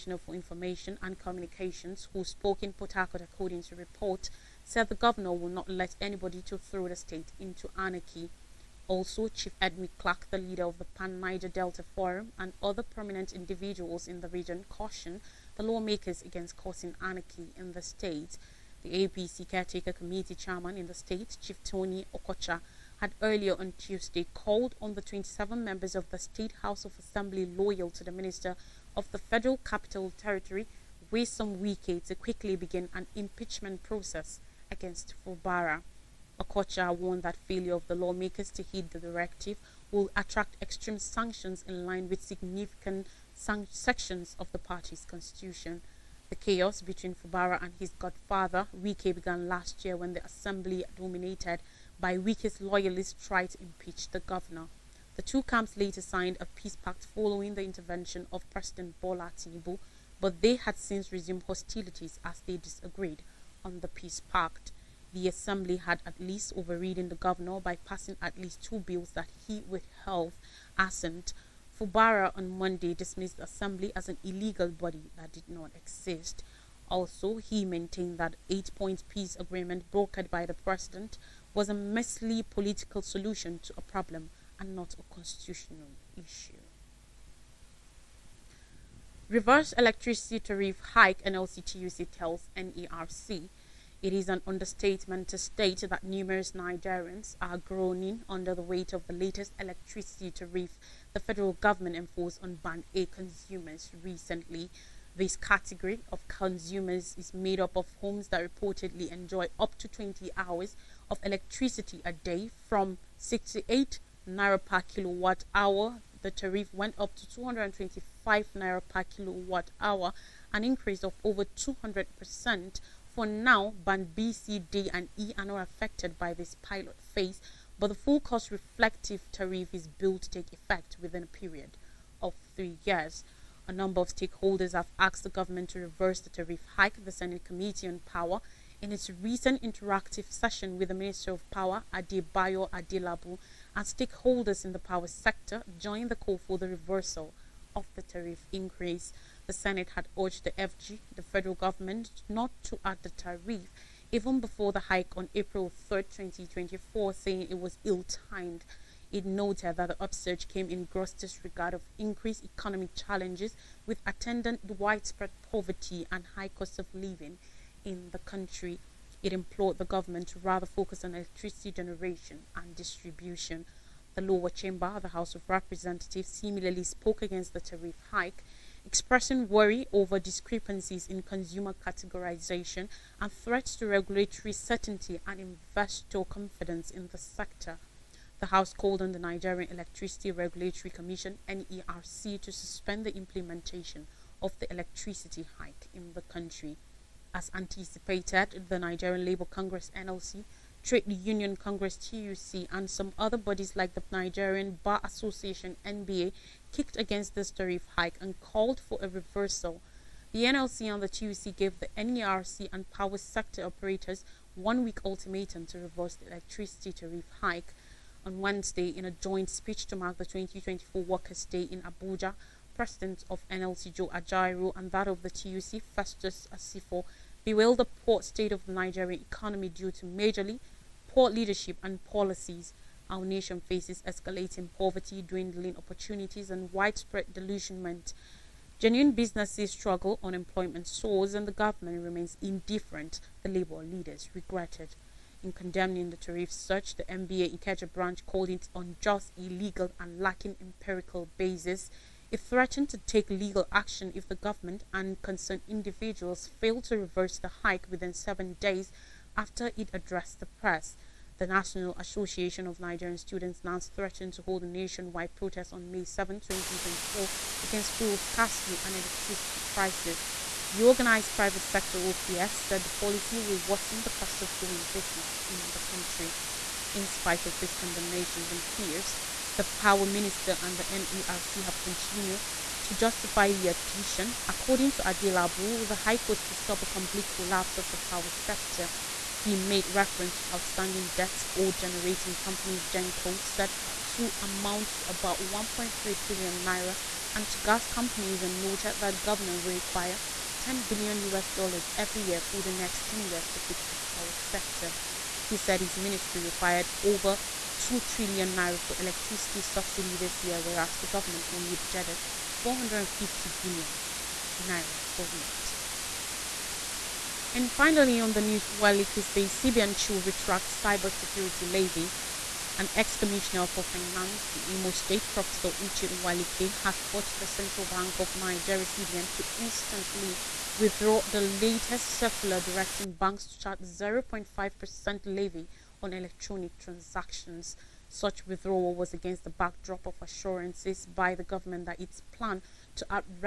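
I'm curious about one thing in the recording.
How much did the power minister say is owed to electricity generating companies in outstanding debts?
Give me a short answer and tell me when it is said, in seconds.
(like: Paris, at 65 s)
1.3 trillion naira, at 295 s.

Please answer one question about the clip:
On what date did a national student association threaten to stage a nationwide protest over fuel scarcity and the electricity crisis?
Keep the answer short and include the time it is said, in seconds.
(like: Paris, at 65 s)
May 7, 2024, at 265 s.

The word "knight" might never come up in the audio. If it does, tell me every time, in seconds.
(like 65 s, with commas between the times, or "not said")
not said.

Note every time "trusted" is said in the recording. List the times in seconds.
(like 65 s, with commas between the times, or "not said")
not said.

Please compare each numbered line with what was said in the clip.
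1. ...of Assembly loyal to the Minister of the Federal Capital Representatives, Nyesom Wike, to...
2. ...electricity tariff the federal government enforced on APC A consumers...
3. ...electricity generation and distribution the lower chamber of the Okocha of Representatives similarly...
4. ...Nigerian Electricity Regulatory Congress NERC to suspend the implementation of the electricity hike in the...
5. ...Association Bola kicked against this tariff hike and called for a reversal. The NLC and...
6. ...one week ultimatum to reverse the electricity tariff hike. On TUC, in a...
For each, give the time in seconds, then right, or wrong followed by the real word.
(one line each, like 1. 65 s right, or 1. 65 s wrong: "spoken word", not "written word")
1. 26 s wrong: "Territory", not "Representatives"
2. 99 s wrong: "Band", not "APC"
3. 171 s wrong: "House", not "Okocha"
4. 189 s wrong: "Commission", not "Congress"
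5. 205 s wrong: "NBA", not "Bola"
6. 214 s wrong: "Wednesday", not "TUC".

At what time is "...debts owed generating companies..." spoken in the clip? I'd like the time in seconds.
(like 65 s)
291 s.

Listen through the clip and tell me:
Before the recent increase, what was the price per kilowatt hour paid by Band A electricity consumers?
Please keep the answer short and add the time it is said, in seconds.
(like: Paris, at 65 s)
68 naira, at 113 s.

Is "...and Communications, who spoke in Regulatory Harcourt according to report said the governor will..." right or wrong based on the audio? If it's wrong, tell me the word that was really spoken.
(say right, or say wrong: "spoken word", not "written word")
wrong: "Port", not "Regulatory".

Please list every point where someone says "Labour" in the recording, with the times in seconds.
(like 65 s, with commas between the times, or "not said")
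199 s, 243 s.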